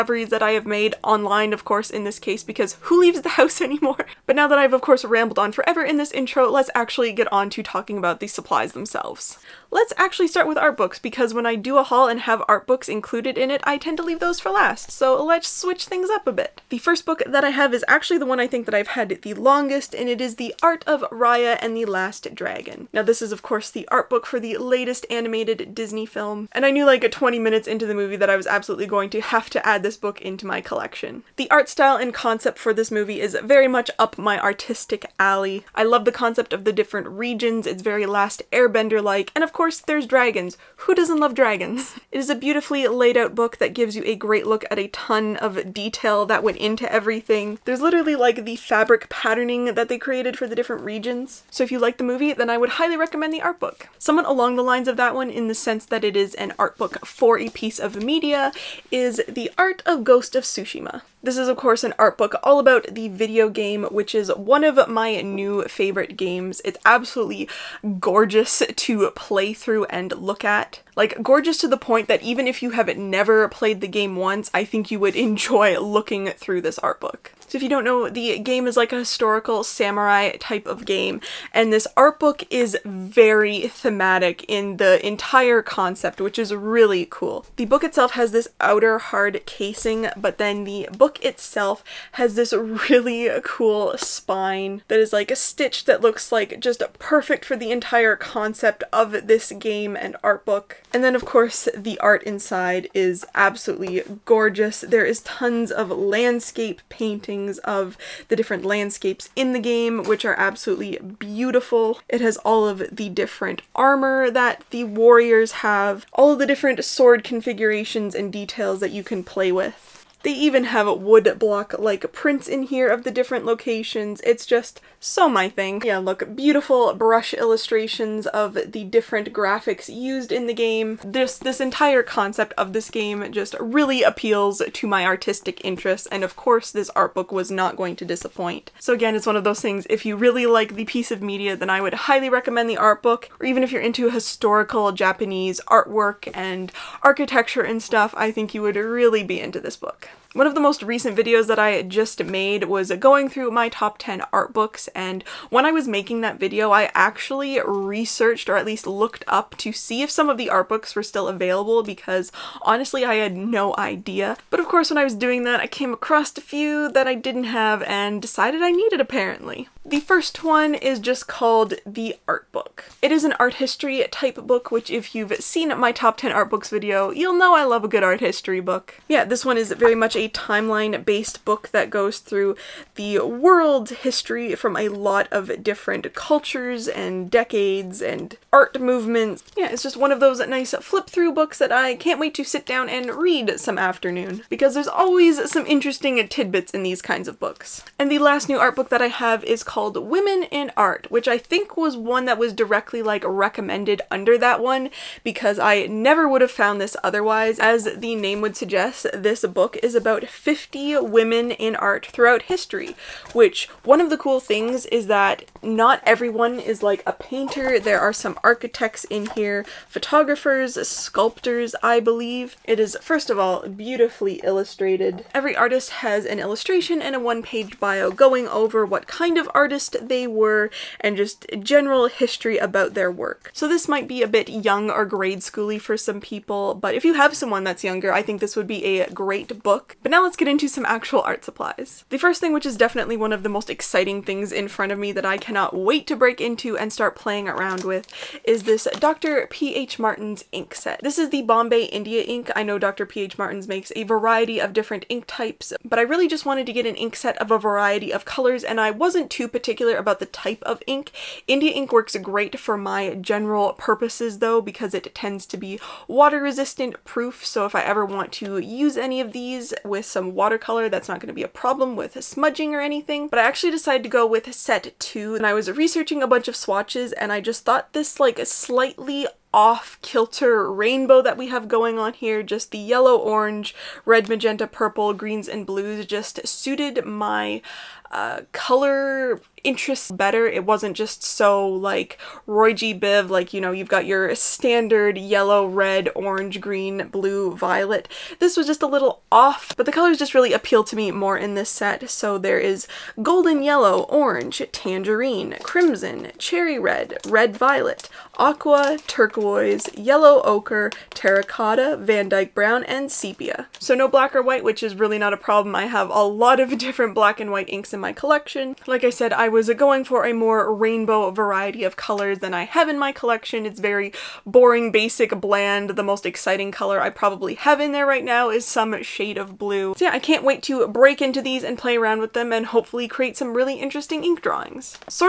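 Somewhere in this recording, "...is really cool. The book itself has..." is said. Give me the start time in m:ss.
1:26.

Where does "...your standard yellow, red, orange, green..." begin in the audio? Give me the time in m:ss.
4:54.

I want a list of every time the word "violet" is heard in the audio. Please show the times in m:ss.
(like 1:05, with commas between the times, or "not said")
4:57, 5:07.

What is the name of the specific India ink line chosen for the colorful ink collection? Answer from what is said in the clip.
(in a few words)
Bombay India ink.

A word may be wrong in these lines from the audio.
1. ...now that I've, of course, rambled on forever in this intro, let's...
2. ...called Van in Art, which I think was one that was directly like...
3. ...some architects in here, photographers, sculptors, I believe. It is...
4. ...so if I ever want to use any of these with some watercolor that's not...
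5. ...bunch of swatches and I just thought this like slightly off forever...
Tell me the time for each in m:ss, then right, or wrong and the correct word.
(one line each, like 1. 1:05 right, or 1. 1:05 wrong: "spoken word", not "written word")
1. 0:04 right
2. 3:19 wrong: "Women", not "Van"
3. 3:38 right
4. 4:27 right
5. 4:36 wrong: "kilter", not "forever".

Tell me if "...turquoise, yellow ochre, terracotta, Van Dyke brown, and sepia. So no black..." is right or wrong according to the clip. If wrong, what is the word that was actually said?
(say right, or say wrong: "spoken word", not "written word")
right.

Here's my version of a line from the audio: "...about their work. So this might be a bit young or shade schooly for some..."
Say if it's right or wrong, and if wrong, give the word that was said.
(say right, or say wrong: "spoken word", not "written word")
wrong: "grade", not "shade".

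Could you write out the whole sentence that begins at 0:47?
There's literally like the fabric patterning that they created for the different regions.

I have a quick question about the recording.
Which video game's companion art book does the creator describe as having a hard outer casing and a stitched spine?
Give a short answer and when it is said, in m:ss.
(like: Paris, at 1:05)
Ghost of Tsushima, at 1:00.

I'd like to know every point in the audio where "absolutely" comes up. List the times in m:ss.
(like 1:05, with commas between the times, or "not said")
0:28, 1:06, 1:43, 1:50.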